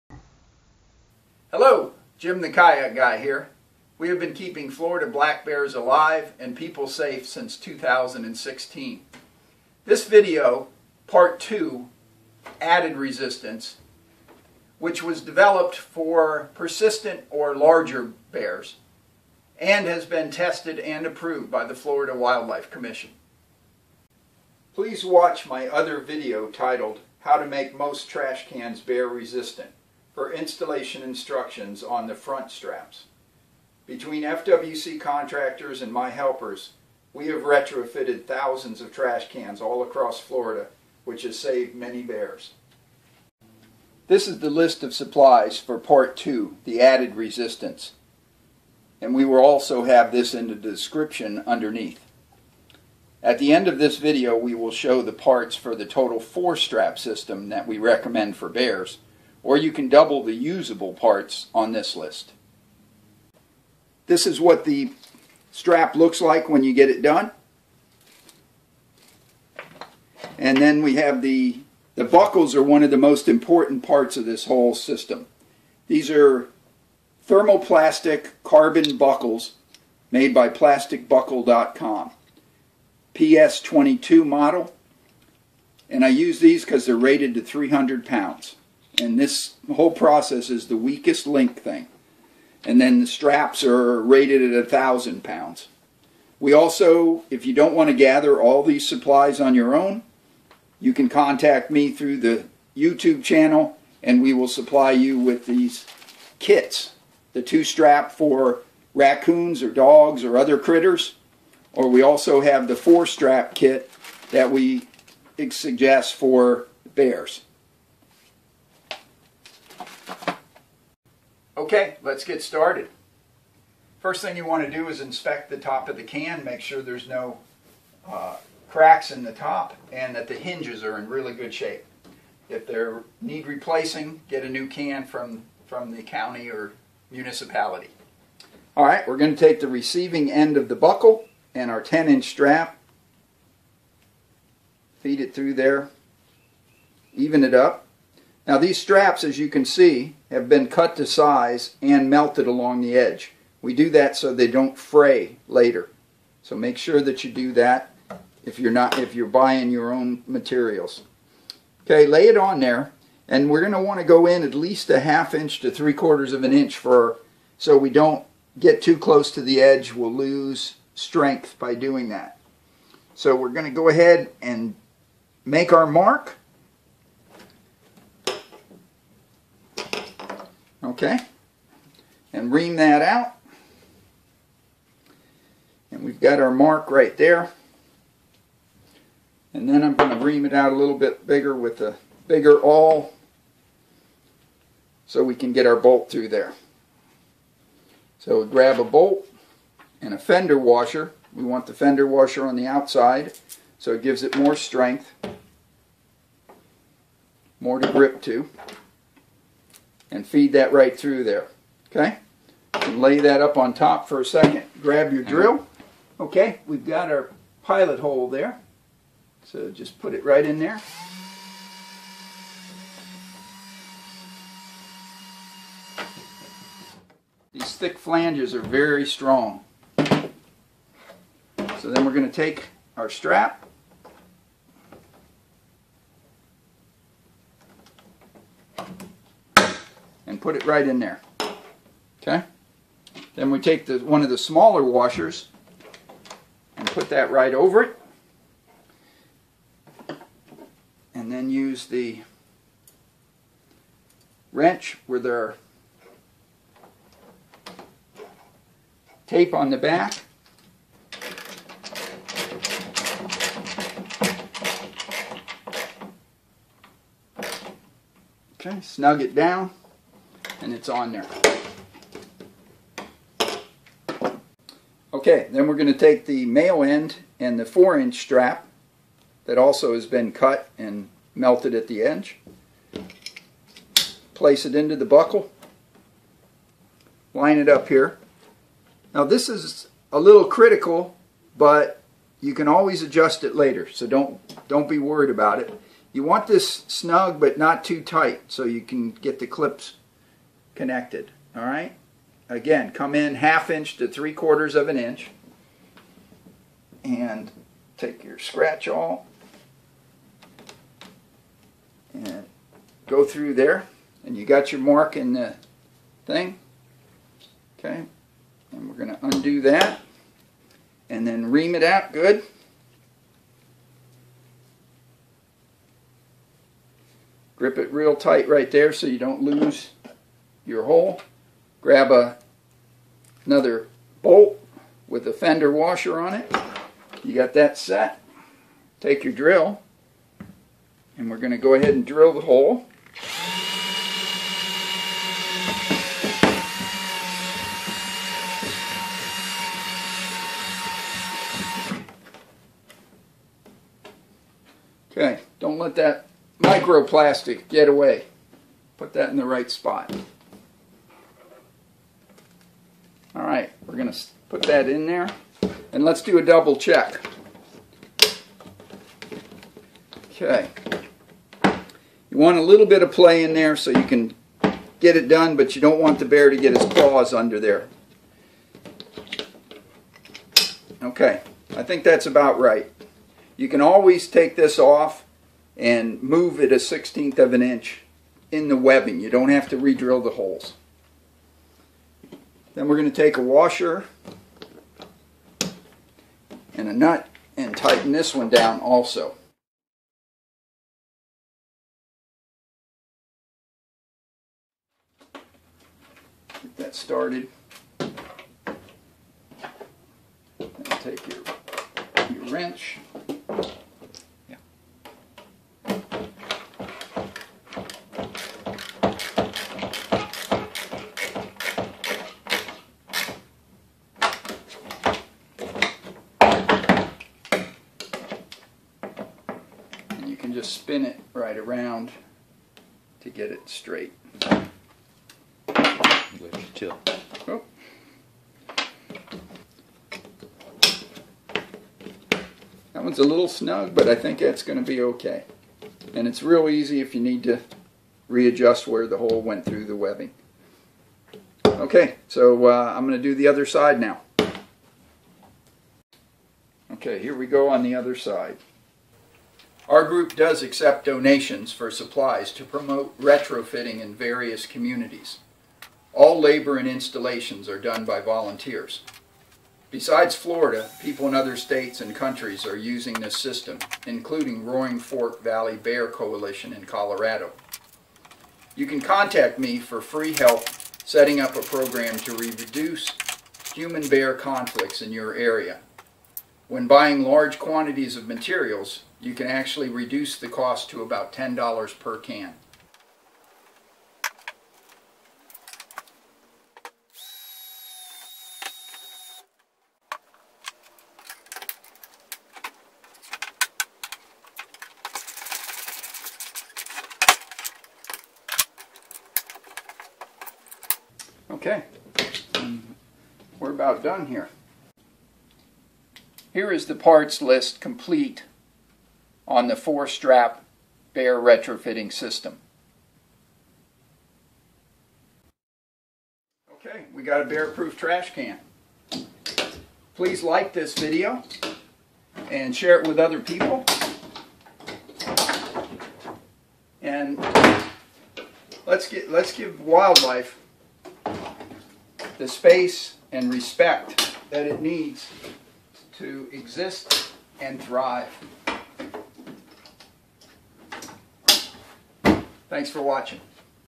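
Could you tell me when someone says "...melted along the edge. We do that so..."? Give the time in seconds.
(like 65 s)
152 s.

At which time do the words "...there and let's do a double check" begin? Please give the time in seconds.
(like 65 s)
365 s.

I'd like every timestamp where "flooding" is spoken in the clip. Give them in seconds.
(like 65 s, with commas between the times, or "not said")
not said.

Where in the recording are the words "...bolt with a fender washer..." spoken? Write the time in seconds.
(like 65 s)
334 s.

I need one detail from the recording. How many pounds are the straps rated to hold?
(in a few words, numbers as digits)
1000 pounds.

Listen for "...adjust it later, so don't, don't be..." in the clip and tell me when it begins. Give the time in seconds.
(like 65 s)
293 s.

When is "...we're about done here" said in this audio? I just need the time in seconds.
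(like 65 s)
513 s.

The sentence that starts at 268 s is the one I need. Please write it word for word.
Okay, snug it down and it's on there.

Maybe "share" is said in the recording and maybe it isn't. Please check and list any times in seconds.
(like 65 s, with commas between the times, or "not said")
532 s.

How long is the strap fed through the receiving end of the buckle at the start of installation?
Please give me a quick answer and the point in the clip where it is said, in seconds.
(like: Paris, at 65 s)
10 inches, at 141 s.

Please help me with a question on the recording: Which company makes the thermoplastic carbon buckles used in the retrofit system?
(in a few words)
plasticbuckle.com.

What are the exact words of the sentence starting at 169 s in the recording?
We'll lose strength by doing that.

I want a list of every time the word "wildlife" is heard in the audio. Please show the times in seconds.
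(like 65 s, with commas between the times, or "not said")
22 s, 539 s.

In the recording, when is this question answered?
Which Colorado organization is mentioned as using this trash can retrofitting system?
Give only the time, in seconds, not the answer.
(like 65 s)
474 s.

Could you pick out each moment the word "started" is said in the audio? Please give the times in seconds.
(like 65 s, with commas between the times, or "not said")
122 s, 406 s.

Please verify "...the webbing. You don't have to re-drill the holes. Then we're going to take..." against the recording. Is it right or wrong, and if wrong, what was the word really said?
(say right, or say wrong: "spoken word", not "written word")
right.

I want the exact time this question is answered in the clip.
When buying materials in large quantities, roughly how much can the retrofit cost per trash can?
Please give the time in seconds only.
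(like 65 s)
491 s.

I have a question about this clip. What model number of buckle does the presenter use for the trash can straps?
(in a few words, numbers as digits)
PS22.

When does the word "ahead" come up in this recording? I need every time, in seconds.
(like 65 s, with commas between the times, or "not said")
173 s, 341 s.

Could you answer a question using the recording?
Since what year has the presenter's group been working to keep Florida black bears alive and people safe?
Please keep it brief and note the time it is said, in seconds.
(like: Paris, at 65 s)
2016, at 7 s.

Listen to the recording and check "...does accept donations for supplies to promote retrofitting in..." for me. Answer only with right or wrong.
right.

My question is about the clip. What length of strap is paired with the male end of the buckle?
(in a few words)
4 inches.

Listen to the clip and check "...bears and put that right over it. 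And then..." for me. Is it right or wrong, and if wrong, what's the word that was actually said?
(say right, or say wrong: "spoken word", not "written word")
wrong: "washers", not "bears".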